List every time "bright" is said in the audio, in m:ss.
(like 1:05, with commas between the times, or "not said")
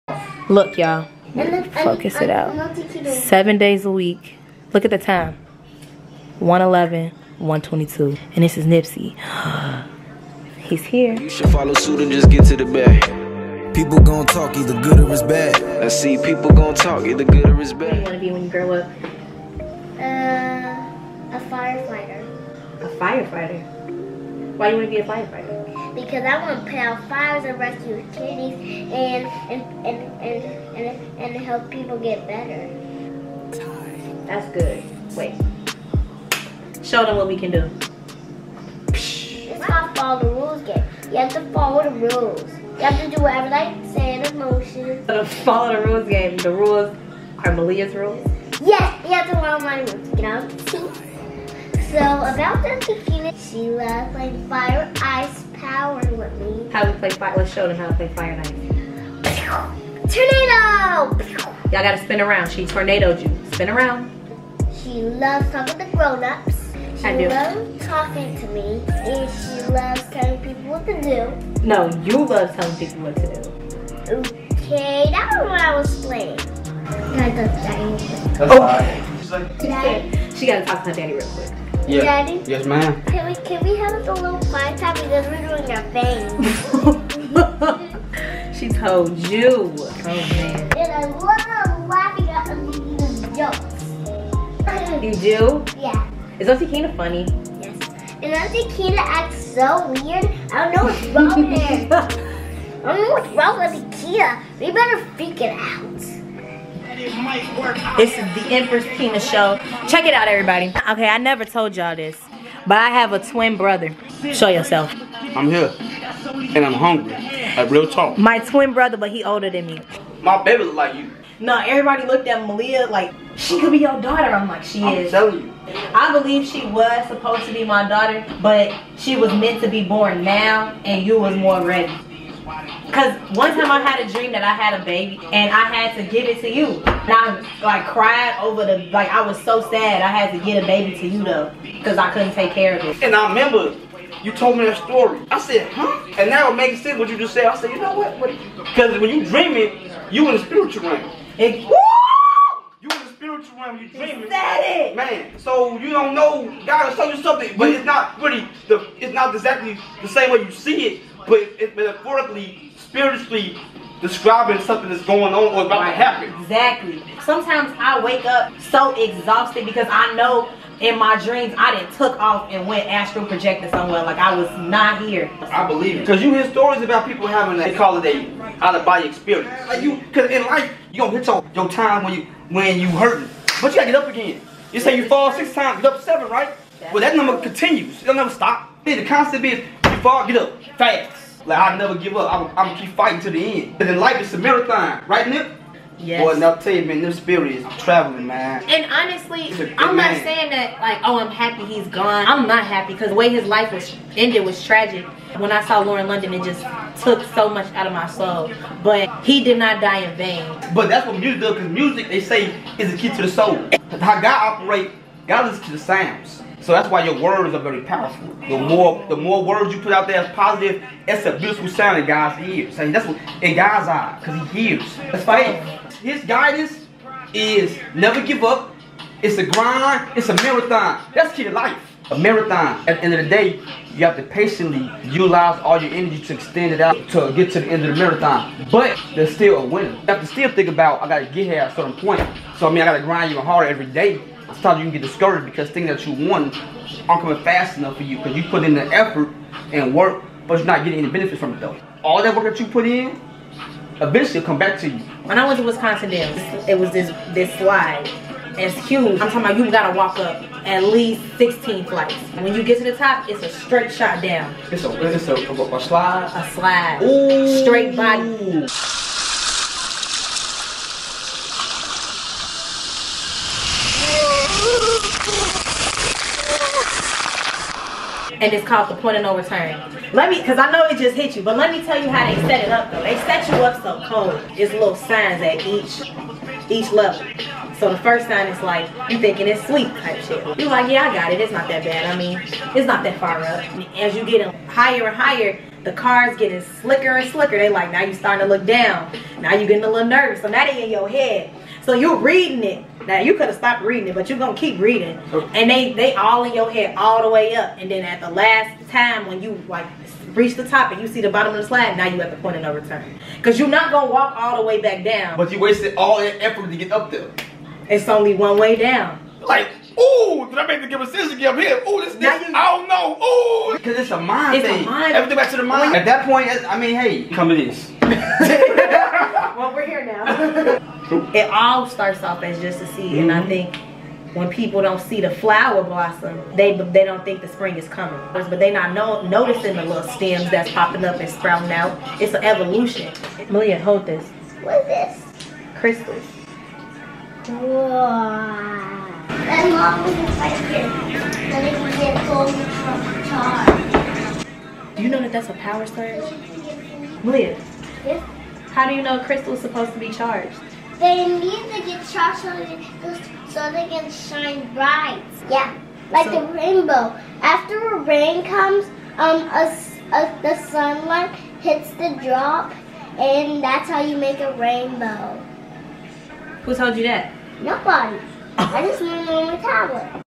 6:04.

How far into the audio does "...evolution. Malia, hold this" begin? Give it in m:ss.
5:42.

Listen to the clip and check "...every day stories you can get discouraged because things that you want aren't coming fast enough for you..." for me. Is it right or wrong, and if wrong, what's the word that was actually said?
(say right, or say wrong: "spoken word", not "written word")
wrong: "sometimes", not "stories".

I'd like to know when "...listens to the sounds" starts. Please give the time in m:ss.
3:35.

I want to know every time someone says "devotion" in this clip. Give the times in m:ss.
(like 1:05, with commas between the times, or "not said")
not said.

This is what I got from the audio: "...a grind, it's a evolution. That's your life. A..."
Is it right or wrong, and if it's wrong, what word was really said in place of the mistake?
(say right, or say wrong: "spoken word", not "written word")
wrong: "marathon", not "evolution".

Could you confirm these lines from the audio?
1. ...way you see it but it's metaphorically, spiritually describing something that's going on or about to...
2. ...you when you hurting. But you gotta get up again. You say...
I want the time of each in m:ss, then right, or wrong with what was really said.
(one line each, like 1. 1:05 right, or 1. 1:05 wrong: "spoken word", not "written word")
1. 2:40 right
2. 3:02 right.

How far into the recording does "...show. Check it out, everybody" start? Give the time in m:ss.
1:49.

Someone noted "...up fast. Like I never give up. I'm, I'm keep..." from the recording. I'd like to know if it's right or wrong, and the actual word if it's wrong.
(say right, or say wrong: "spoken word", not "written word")
right.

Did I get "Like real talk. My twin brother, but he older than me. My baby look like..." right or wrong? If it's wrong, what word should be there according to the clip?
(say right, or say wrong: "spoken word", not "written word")
right.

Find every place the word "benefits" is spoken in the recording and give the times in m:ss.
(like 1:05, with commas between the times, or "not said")
4:11.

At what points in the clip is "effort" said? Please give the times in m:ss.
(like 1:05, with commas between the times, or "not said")
4:08, 5:16.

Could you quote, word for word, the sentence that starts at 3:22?
I'm not happy because the way his life was ended was tragic.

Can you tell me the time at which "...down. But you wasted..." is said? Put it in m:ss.
5:15.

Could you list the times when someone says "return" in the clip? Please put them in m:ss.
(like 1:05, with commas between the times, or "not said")
4:39, 5:12.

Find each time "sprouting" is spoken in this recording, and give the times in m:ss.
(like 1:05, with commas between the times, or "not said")
5:41.